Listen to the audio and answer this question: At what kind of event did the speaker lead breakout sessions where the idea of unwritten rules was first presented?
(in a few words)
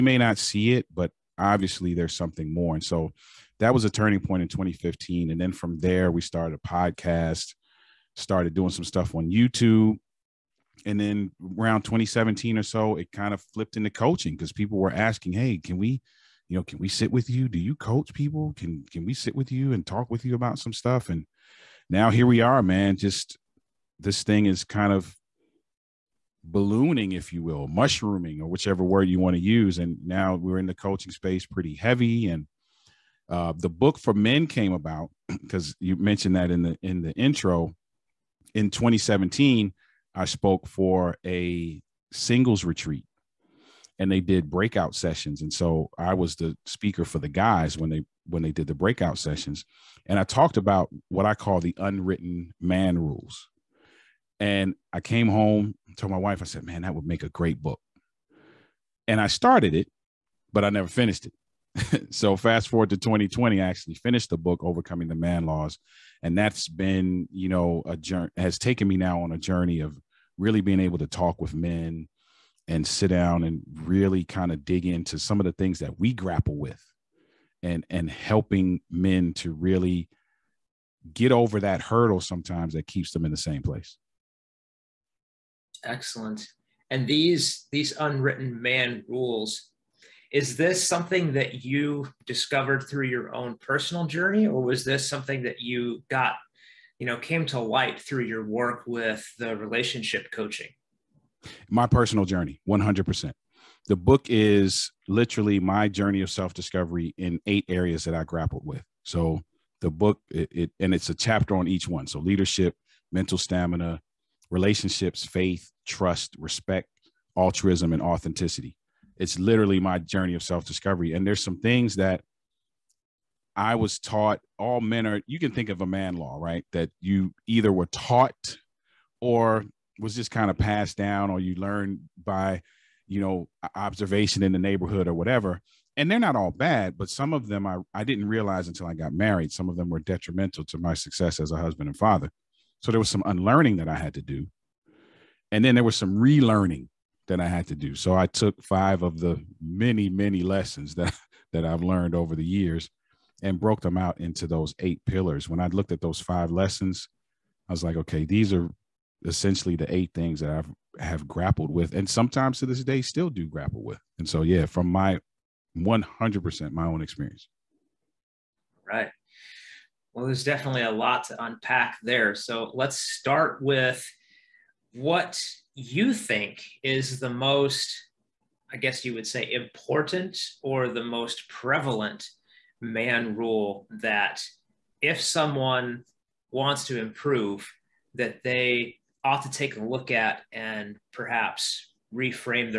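Singles retreat.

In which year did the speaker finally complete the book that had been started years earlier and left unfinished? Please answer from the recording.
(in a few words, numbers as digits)
2020.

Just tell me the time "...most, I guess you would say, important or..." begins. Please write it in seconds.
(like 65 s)
177 s.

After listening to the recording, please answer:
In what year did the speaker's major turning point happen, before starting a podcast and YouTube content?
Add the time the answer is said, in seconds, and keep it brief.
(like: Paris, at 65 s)
2015, at 4 s.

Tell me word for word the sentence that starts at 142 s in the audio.
So there was some unlearning that I had to do and then there was some relearning that I had to do.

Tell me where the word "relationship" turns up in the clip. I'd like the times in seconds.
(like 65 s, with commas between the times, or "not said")
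99 s, 114 s.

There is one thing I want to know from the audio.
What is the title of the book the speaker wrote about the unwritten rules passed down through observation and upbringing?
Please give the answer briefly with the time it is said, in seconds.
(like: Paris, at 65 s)
Overcoming the Man Laws, at 64 s.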